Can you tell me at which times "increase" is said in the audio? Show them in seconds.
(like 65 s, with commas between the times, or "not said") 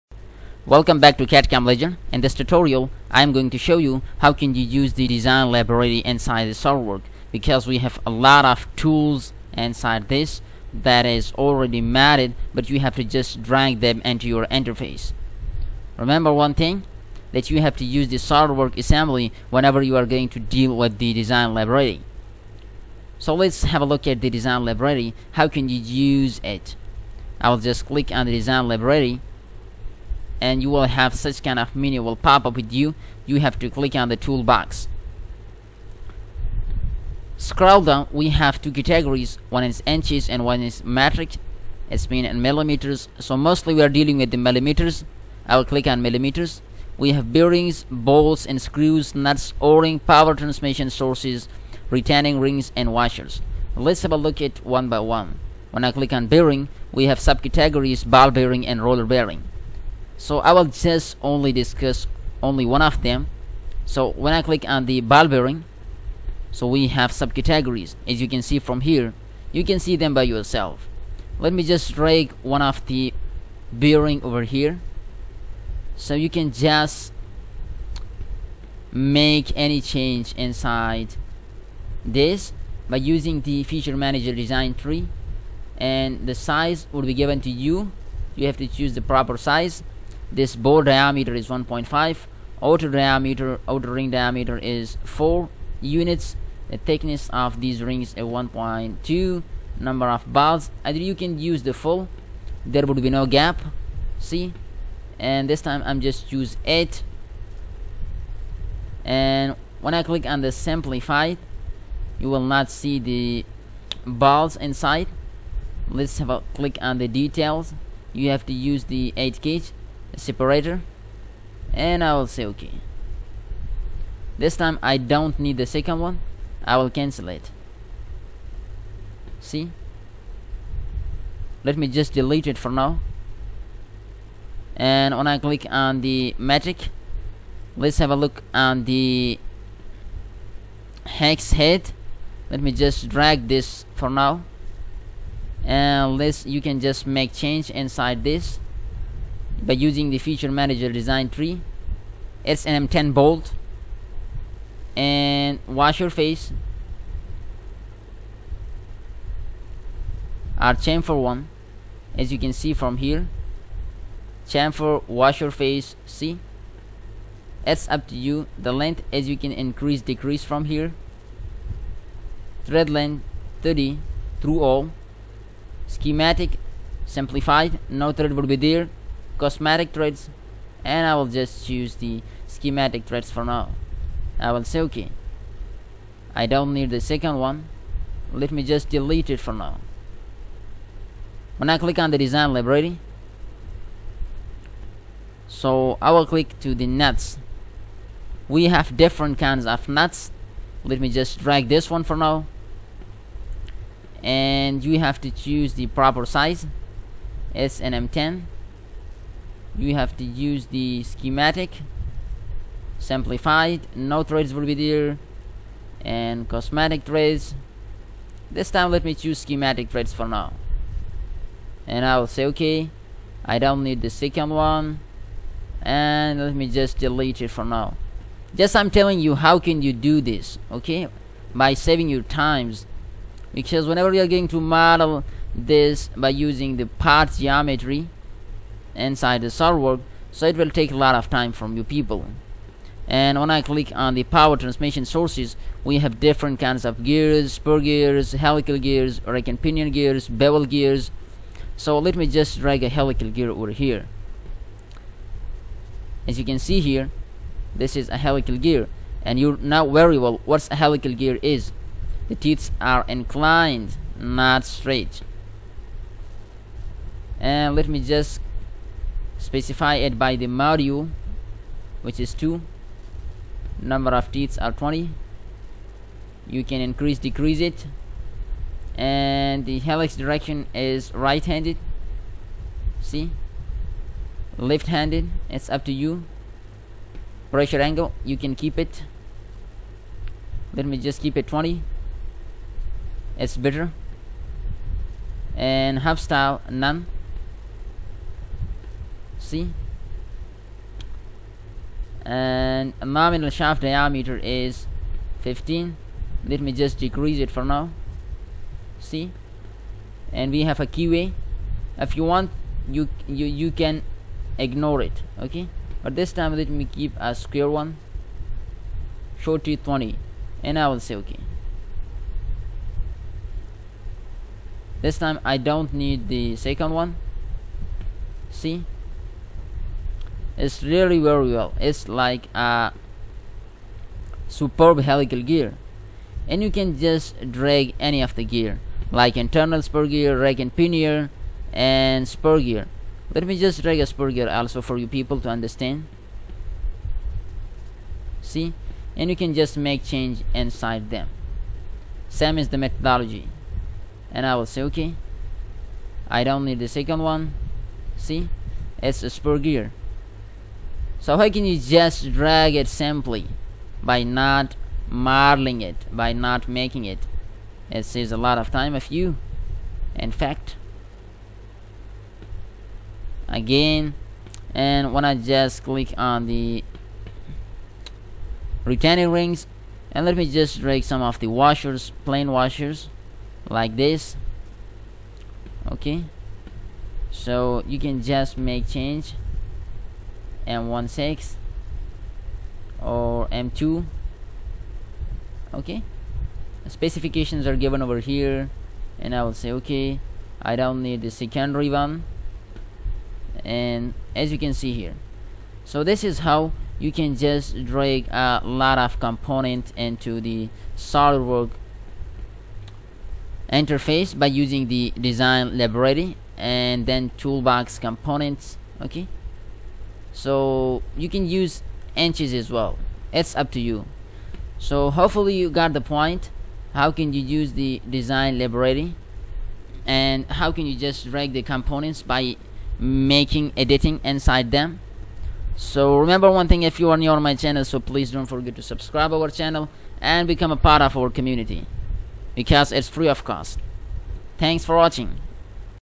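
169 s, 276 s.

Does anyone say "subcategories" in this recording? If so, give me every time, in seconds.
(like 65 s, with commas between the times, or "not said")
57 s, 67 s.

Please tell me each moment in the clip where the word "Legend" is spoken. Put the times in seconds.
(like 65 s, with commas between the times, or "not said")
1 s.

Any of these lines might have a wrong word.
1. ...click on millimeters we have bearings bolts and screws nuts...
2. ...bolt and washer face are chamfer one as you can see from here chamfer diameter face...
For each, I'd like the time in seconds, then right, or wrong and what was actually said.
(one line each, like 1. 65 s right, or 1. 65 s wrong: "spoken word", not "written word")
1. 45 s right
2. 153 s wrong: "washer", not "diameter".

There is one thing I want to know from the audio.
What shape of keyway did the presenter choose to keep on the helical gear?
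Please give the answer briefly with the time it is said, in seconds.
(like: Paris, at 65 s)
square, at 317 s.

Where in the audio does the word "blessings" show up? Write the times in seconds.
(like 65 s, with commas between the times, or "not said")
not said.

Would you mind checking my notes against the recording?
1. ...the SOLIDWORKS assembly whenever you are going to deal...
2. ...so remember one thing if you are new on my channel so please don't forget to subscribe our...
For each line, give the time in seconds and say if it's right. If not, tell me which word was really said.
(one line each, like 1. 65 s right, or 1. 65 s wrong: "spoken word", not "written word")
1. 18 s right
2. 435 s right.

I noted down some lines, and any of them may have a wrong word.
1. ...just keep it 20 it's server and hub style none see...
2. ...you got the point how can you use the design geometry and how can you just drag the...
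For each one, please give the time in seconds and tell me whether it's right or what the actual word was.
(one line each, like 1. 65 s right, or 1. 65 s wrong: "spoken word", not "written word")
1. 290 s wrong: "better", not "server"
2. 425 s wrong: "library", not "geometry".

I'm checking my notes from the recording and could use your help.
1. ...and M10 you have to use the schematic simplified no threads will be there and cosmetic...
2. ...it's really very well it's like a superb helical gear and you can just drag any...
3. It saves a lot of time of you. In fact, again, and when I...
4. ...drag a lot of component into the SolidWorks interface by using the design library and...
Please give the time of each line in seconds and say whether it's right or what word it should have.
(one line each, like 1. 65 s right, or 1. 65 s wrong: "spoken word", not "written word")
1. 207 s right
2. 330 s right
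3. 367 s right
4. 407 s right.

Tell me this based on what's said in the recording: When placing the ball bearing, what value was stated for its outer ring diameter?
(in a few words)
4 units.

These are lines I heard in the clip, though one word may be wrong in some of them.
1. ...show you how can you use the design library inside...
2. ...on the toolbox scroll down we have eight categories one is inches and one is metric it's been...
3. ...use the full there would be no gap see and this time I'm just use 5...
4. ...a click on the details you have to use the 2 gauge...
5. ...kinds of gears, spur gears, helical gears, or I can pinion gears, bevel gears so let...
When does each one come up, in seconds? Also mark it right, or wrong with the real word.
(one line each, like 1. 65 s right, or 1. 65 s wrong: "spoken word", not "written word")
1. 3 s right
2. 33 s wrong: "two", not "eight"
3. 101 s wrong: "8", not "5"
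4. 116 s wrong: "8", not "2"
5. 246 s right.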